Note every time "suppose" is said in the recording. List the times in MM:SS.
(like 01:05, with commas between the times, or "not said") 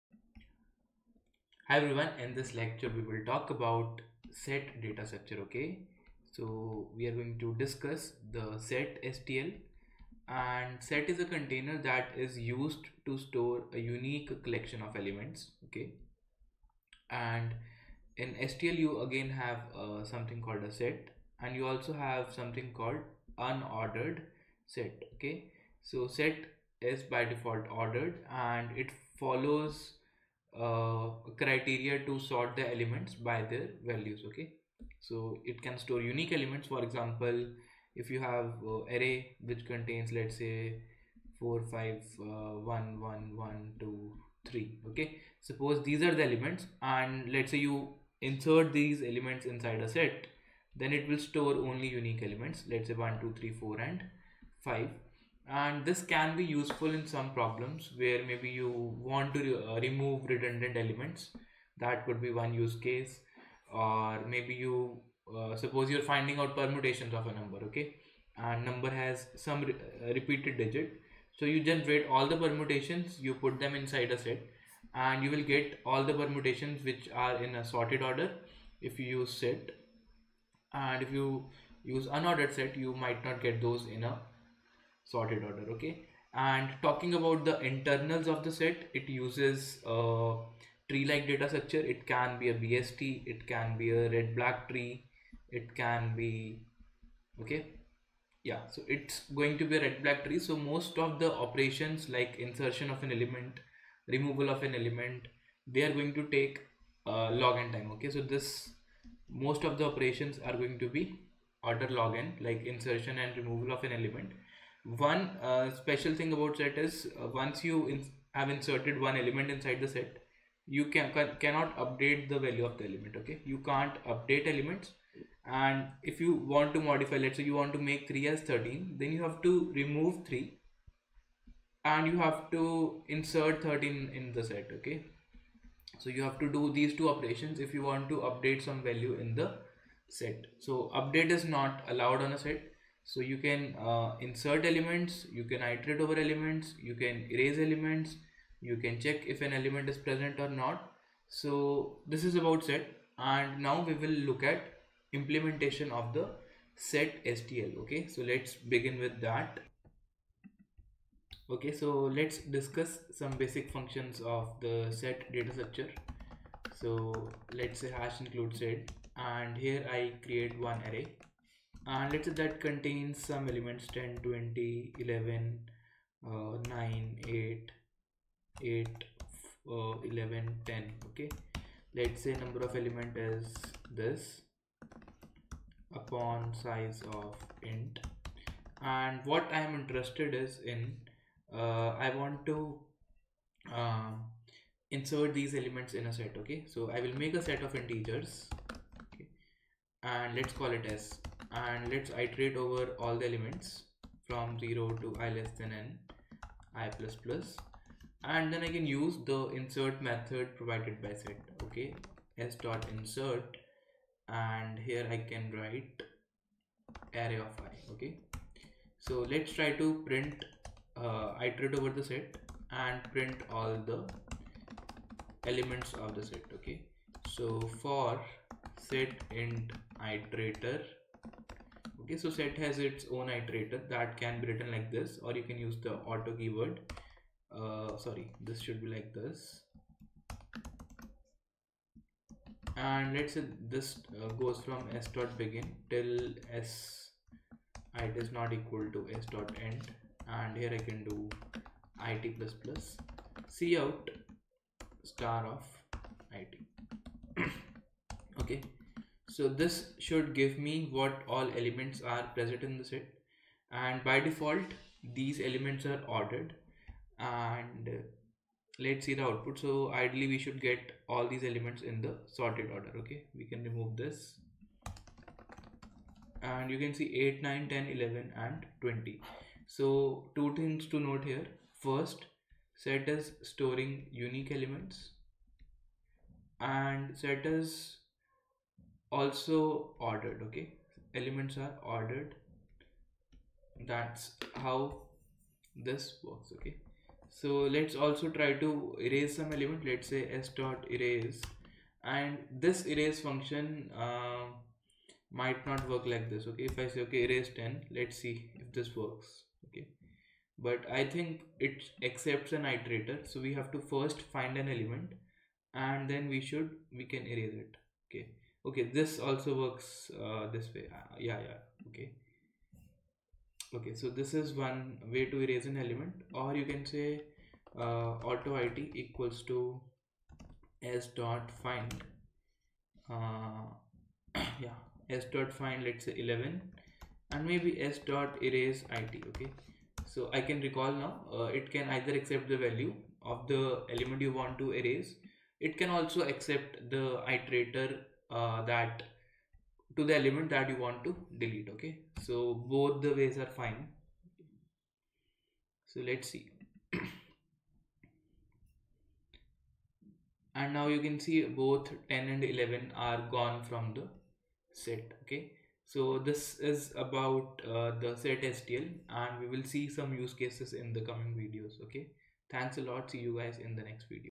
00:45, 01:05.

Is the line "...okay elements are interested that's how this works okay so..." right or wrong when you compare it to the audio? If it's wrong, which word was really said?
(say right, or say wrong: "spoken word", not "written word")
wrong: "ordered", not "interested".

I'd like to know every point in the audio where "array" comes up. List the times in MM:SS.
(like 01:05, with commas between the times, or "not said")
00:38, 02:50, 03:37.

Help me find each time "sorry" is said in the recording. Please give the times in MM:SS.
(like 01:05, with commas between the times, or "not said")
03:57.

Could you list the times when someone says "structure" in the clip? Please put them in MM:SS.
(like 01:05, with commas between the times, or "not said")
00:05, 01:31, 02:45.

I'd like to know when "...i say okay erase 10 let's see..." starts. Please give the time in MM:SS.
05:06.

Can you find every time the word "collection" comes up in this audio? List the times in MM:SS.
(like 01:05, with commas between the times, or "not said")
00:14.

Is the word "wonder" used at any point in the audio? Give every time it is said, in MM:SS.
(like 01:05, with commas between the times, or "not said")
not said.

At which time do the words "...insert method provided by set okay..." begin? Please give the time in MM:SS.
03:29.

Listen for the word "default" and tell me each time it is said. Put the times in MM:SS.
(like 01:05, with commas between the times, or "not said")
00:27, 04:24.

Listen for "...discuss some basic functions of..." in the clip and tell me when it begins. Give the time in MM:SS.
02:42.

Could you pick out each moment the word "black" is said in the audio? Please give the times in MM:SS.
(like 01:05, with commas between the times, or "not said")
01:34, 01:40.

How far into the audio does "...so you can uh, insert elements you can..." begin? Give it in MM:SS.
02:23.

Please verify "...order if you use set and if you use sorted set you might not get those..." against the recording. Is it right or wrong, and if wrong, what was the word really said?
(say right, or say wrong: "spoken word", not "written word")
wrong: "unordered", not "sorted".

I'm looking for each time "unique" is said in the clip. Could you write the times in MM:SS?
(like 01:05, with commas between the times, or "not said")
00:13, 00:36, 00:51, 04:44.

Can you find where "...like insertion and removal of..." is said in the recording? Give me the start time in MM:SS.
01:52.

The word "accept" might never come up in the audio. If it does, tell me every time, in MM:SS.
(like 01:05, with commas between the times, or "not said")
05:12, 05:42, 05:46.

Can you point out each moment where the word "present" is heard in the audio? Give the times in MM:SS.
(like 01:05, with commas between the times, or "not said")
02:29, 04:22.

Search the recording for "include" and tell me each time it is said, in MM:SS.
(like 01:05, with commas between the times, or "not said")
02:48.